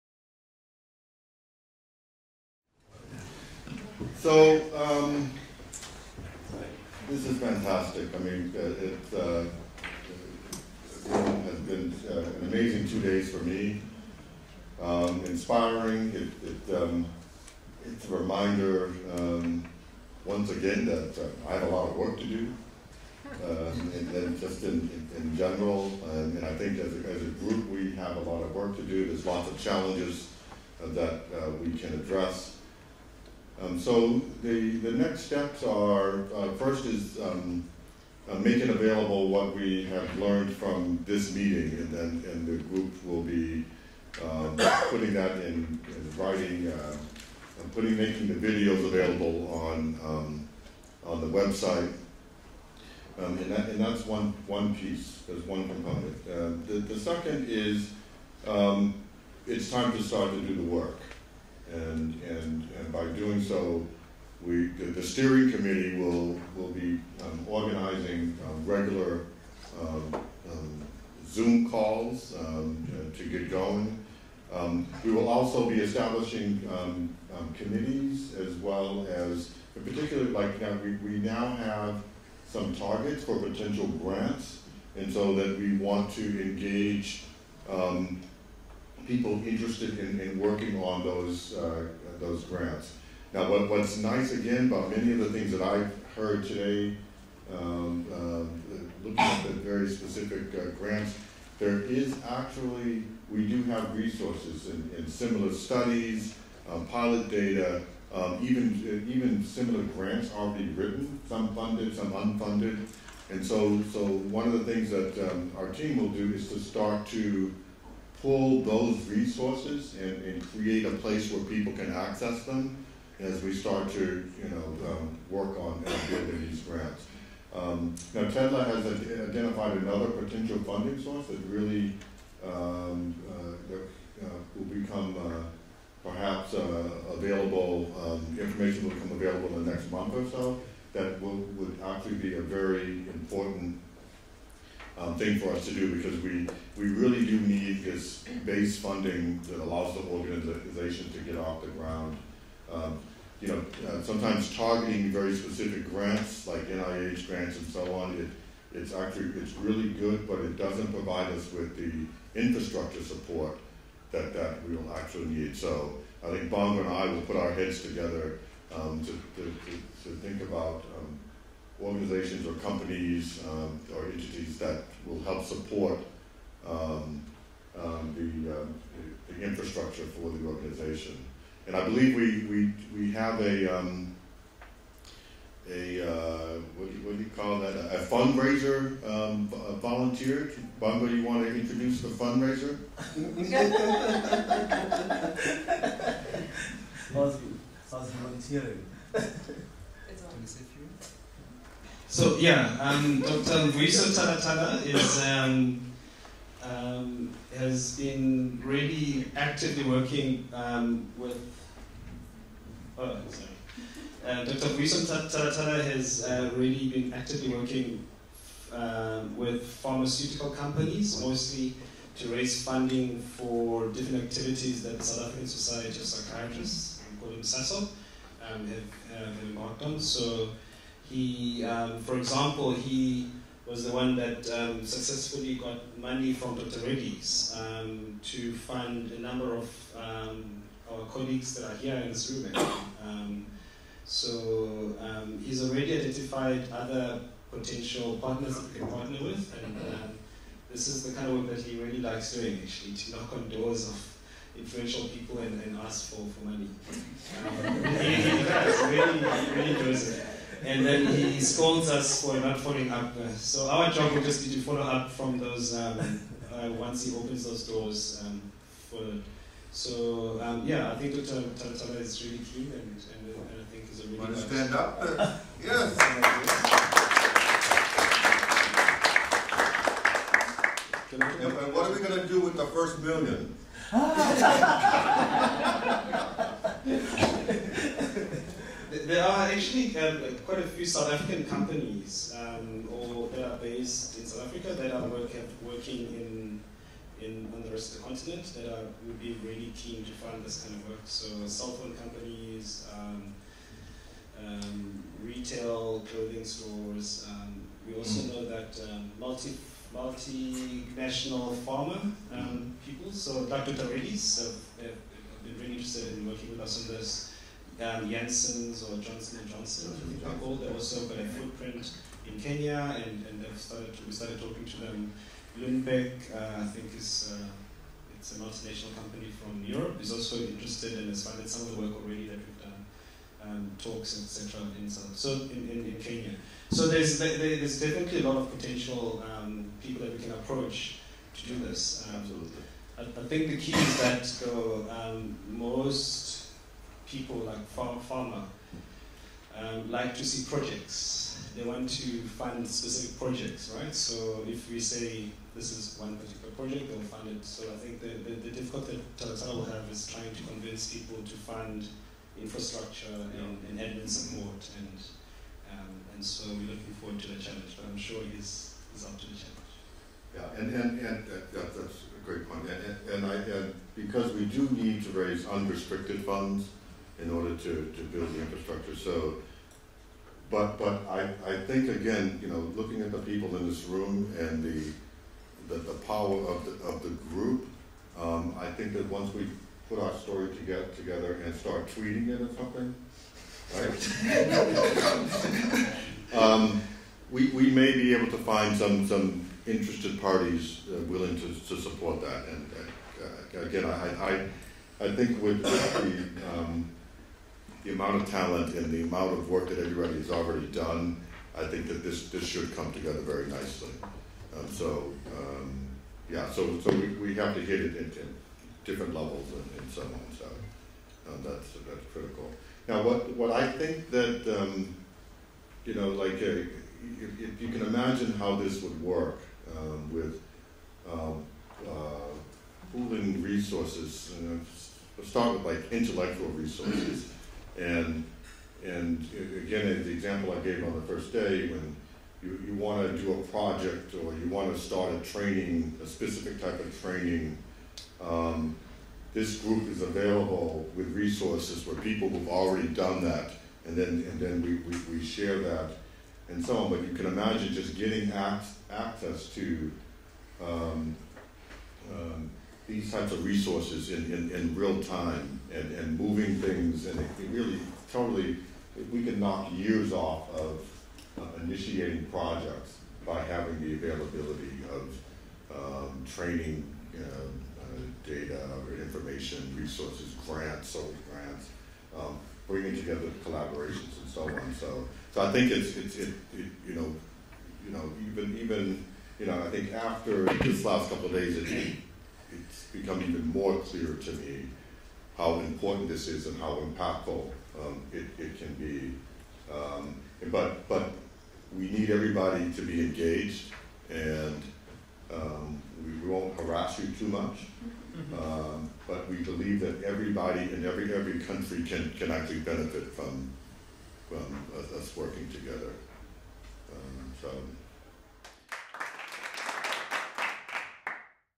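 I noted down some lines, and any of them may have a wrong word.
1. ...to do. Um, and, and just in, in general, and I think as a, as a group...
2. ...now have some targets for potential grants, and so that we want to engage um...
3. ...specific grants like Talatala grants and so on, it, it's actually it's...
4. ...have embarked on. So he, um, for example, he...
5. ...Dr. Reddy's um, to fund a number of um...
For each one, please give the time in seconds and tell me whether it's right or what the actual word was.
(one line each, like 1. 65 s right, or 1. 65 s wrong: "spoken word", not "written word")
1. 22 s right
2. 81 s right
3. 155 s wrong: "NIH", not "Talatala"
4. 229 s right
5. 236 s right.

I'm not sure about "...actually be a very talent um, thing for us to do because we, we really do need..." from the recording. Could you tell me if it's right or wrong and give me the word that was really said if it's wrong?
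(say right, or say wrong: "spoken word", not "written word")
wrong: "important", not "talent".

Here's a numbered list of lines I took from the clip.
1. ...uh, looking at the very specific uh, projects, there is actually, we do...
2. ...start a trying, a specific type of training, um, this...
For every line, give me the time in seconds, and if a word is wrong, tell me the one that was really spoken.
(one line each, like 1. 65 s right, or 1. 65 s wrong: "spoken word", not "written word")
1. 98 s wrong: "grants", not "projects"
2. 444 s wrong: "training", not "trying".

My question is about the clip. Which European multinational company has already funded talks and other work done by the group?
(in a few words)
Lundbeck.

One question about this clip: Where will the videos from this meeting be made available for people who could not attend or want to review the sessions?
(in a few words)
the website.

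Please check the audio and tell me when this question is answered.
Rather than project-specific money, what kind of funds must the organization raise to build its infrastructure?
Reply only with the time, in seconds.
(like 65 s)
375 s.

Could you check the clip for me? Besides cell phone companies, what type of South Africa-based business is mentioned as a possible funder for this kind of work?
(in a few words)
retail clothing stores.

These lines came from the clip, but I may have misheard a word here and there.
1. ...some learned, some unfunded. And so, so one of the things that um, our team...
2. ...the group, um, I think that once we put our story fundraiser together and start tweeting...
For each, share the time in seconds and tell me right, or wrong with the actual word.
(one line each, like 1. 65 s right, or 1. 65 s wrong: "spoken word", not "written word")
1. 111 s wrong: "funded", not "learned"
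2. 387 s wrong: "together", not "fundraiser".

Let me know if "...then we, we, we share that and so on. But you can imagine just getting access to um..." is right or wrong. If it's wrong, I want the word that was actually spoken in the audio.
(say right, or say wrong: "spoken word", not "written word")
right.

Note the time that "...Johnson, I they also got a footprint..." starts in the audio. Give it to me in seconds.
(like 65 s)
319 s.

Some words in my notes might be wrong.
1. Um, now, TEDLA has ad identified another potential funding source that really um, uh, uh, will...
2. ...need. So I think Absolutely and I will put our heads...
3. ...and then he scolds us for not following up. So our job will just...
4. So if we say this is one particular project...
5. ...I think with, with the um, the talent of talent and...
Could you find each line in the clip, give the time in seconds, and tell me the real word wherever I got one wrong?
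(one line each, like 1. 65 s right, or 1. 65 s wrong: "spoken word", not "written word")
1. 127 s right
2. 165 s wrong: "Bonga", not "Absolutely"
3. 260 s right
4. 353 s right
5. 405 s wrong: "amount", not "talent".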